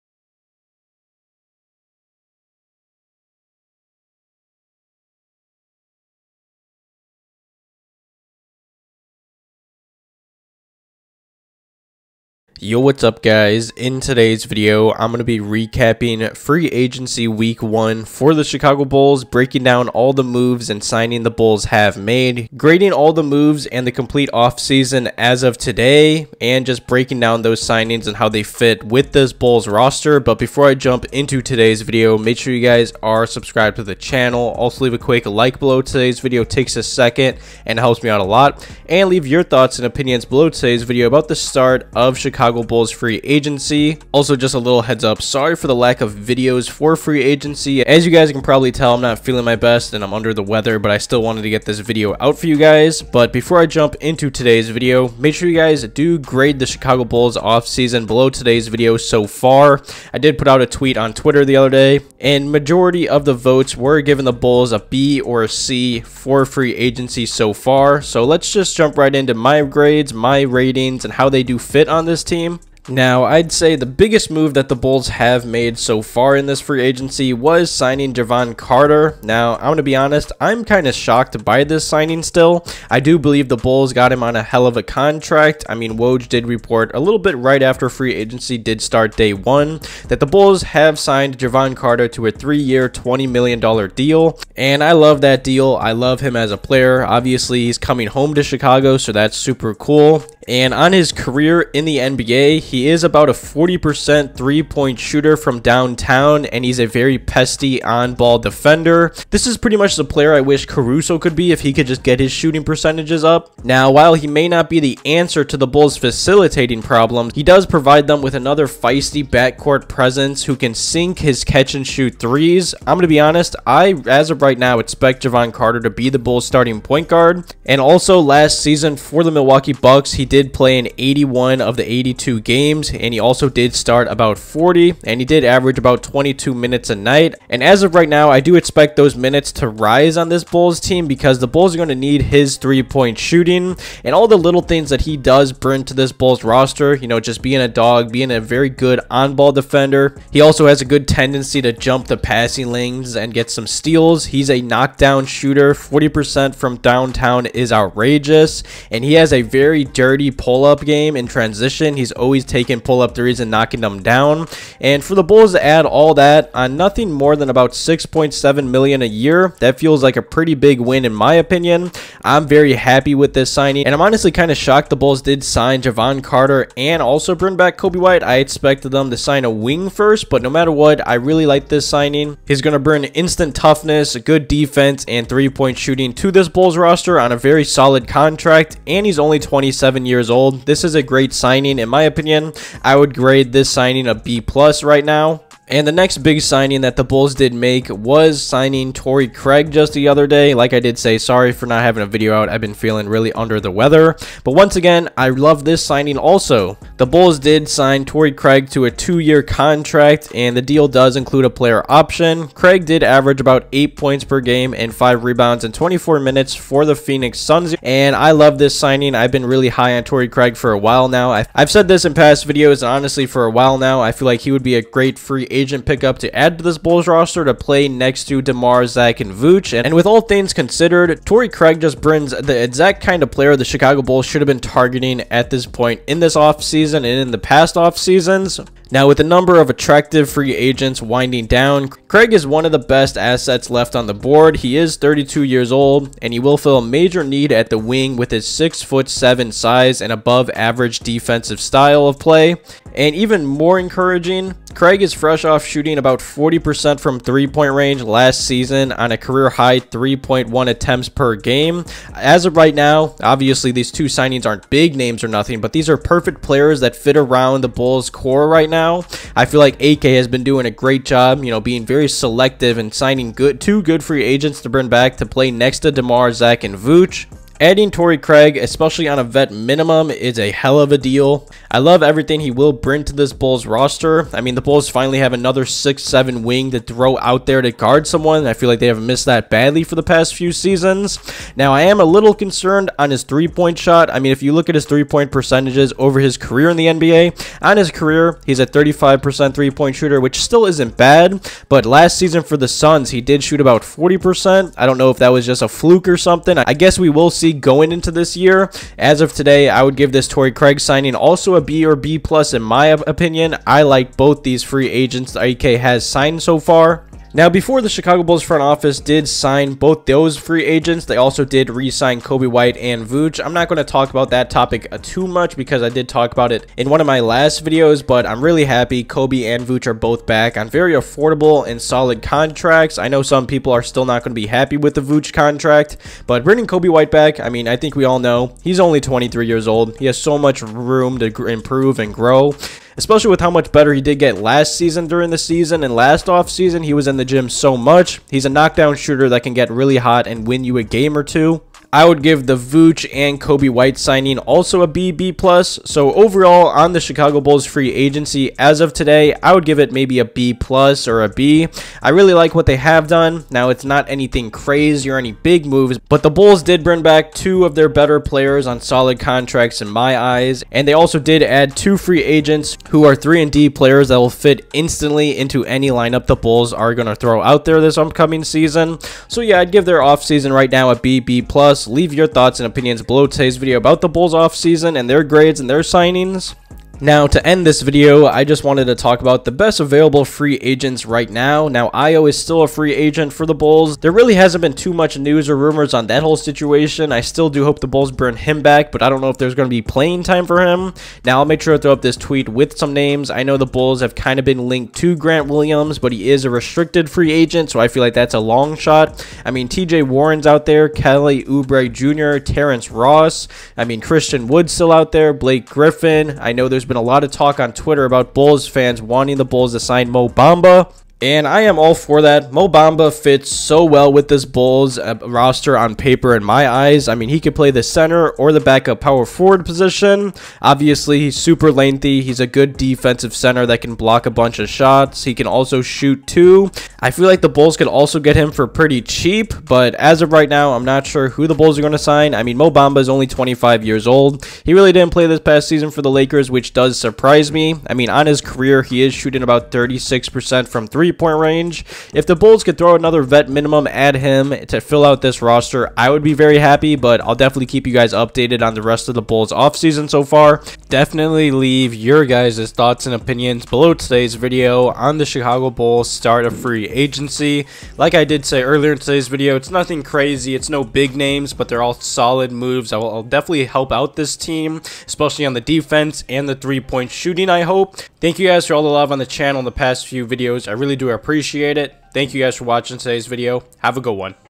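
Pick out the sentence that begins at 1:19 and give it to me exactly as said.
Now, I'm going to be honest, I'm kind of shocked by this signing still.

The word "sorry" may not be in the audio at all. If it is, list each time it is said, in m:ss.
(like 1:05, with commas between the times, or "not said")
0:45, 3:21.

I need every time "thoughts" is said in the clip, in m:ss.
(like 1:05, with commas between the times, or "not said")
0:39, 6:22, 7:42.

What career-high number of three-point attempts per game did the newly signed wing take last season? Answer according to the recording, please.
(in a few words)
3.1.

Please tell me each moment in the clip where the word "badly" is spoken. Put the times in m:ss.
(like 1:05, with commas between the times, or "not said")
4:49.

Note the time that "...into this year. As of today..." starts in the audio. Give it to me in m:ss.
5:07.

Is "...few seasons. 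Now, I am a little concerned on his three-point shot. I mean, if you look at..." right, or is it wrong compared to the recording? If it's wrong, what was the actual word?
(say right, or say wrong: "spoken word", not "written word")
right.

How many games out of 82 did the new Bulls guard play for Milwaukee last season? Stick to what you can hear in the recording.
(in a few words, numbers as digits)
81.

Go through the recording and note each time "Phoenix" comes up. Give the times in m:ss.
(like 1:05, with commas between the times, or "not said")
3:36.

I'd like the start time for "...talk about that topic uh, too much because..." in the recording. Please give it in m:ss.
5:23.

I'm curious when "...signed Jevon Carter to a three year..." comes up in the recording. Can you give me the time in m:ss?
1:30.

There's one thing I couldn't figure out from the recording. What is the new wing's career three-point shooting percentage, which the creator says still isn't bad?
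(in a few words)
35%.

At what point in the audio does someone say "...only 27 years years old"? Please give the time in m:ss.
3:09.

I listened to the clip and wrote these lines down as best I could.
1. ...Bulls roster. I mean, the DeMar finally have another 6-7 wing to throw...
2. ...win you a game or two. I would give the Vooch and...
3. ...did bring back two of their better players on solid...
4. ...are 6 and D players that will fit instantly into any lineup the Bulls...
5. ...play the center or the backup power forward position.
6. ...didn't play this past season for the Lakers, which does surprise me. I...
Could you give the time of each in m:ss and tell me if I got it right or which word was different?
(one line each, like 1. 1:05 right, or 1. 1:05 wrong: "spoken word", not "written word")
1. 4:43 wrong: "Bulls", not "DeMar"
2. 5:50 right
3. 6:06 right
4. 6:13 wrong: "3", not "6"
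5. 7:07 right
6. 7:24 right.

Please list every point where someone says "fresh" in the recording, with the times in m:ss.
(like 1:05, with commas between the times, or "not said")
4:15.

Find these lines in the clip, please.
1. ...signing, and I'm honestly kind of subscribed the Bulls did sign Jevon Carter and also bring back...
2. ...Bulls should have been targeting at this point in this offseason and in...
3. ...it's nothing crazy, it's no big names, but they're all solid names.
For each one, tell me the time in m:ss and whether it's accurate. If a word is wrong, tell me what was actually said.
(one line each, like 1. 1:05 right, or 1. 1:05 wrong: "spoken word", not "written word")
1. 2:53 wrong: "shocked", not "subscribed"
2. 3:54 right
3. 7:49 wrong: "moves", not "names".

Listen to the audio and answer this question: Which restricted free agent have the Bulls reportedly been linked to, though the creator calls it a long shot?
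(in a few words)
Grant Williams.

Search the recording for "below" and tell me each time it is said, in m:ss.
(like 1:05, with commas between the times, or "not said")
0:35, 0:40, 0:58, 6:23, 7:43.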